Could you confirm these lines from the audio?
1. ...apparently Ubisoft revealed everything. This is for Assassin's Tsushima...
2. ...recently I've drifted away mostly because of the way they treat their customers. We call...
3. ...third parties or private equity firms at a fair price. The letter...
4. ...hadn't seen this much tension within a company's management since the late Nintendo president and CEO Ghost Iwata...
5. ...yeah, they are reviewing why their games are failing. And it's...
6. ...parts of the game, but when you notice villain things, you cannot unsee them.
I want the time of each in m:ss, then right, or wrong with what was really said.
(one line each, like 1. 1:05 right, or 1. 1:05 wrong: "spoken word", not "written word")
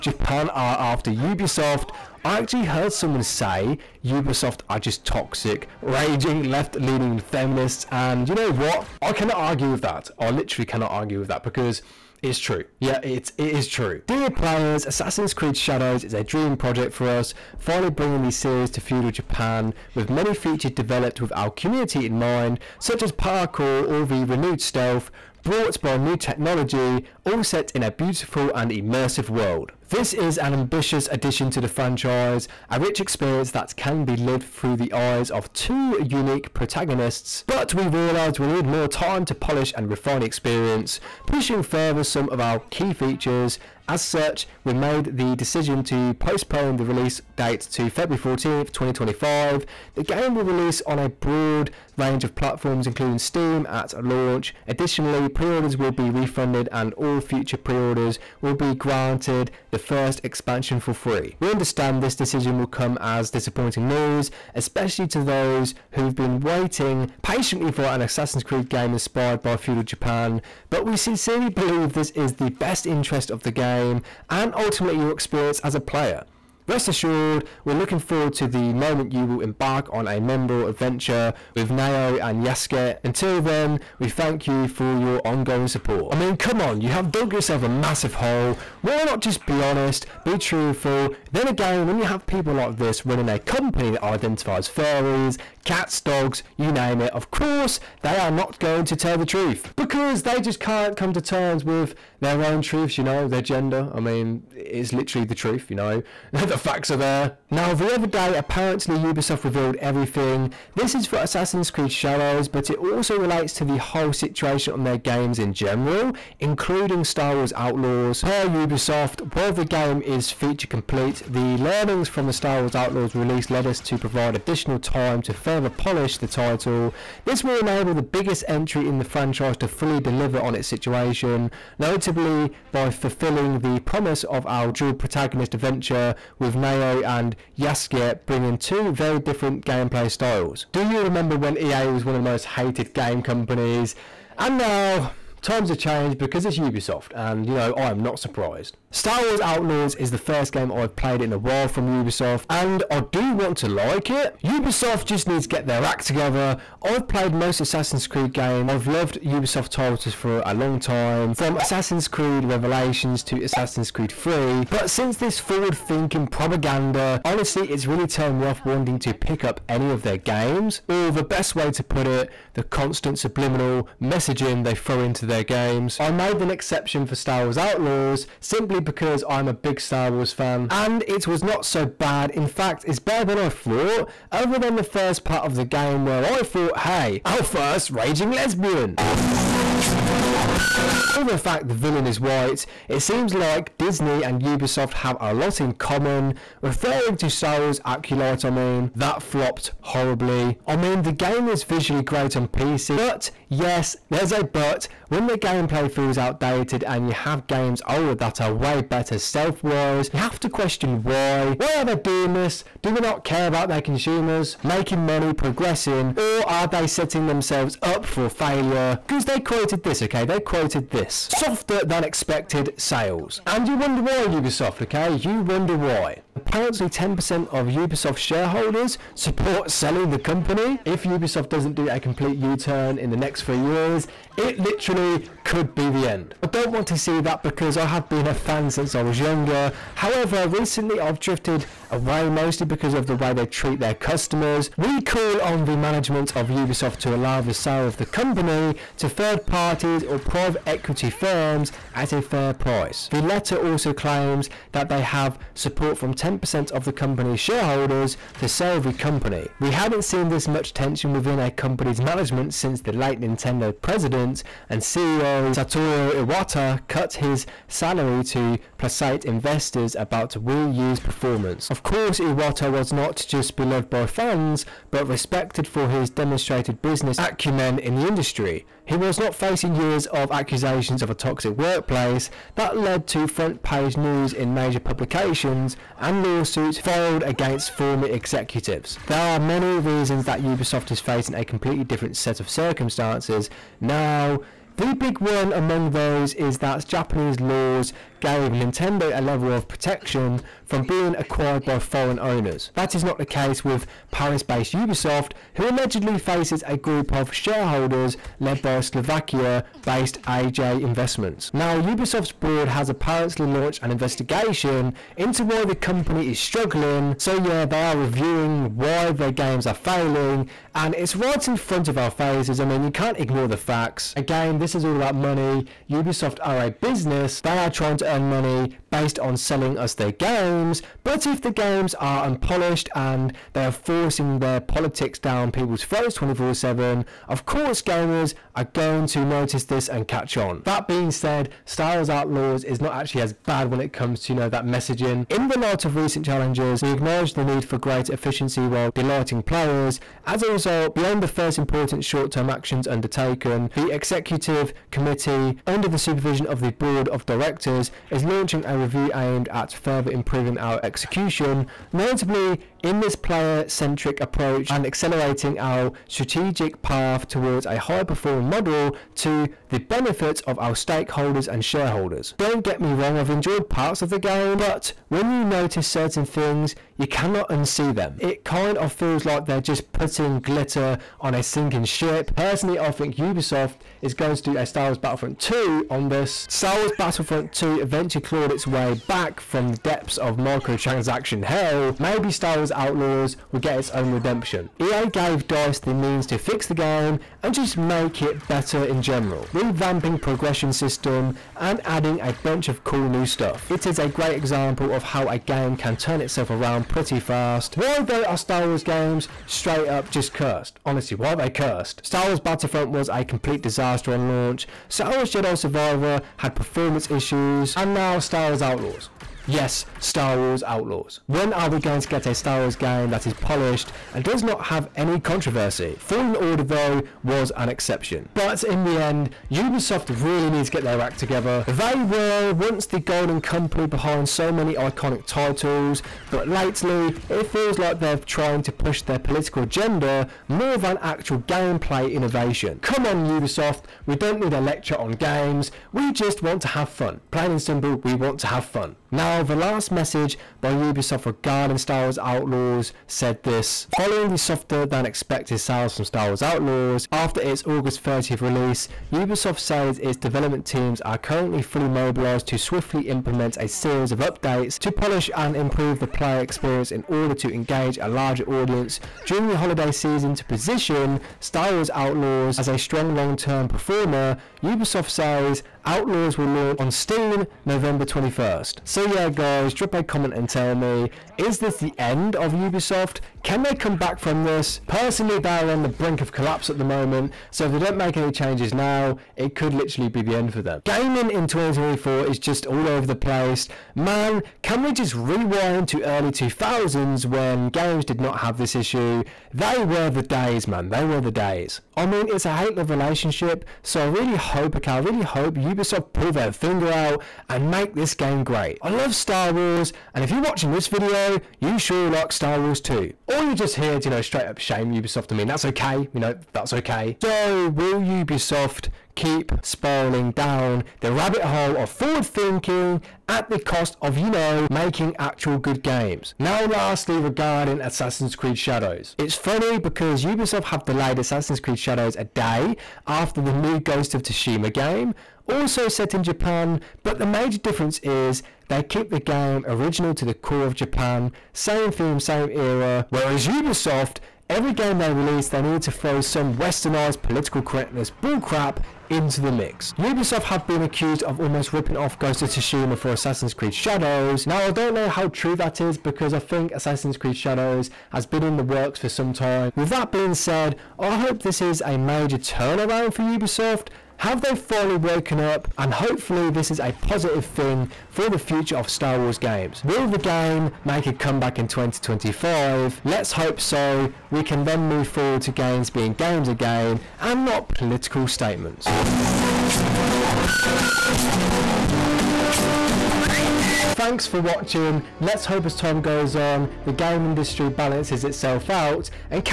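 1. 1:48 wrong: "Creed", not "Tsushima"
2. 4:00 right
3. 4:09 right
4. 4:19 wrong: "Satoru", not "Ghost"
5. 5:17 right
6. 6:13 wrong: "certain", not "villain".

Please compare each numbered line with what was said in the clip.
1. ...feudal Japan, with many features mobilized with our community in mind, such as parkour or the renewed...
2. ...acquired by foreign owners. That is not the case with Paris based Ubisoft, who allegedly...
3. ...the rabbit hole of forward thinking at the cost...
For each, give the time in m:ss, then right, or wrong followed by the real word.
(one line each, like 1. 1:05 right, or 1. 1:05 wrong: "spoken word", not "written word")
1. 0:18 wrong: "developed", not "mobilized"
2. 5:01 right
3. 8:41 right.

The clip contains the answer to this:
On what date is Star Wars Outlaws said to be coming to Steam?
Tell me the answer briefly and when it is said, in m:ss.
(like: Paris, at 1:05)
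November 21st, at 7:57.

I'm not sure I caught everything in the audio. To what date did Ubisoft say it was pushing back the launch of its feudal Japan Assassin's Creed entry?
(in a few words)
February 14th, 2025.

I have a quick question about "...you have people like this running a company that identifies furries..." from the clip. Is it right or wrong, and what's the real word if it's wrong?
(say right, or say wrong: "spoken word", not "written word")
right.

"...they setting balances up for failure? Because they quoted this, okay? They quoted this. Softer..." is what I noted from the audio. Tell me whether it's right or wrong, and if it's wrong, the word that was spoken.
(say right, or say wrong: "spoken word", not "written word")
wrong: "themselves", not "balances".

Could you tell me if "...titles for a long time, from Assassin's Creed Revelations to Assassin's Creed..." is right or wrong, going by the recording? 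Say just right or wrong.
right.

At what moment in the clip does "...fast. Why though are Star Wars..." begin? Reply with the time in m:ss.
6:47.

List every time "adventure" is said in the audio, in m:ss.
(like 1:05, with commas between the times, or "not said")
1:20, 2:15.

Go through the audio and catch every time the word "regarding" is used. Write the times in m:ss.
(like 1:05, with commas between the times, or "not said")
7:31, 8:47.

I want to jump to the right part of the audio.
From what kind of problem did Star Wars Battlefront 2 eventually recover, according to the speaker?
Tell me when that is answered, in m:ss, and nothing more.
6:30.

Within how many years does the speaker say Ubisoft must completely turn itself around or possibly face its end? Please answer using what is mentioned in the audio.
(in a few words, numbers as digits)
3 years.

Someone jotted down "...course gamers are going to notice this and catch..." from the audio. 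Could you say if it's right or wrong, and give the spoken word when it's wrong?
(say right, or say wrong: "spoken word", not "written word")
right.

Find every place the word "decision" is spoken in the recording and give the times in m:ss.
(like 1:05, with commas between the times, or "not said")
0:45, 1:02.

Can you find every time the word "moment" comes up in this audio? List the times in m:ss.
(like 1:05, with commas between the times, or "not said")
1:18, 8:06.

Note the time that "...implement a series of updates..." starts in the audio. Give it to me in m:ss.
7:43.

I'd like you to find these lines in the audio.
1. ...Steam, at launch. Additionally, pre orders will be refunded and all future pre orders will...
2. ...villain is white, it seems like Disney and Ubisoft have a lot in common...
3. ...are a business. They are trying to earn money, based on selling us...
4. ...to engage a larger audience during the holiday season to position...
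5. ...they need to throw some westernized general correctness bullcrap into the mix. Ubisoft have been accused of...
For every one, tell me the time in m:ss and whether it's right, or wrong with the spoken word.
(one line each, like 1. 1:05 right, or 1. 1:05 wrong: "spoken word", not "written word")
1. 0:53 right
2. 3:11 right
3. 5:26 right
4. 7:47 right
5. 9:05 wrong: "political", not "general".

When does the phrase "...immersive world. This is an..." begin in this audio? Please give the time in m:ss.
0:28.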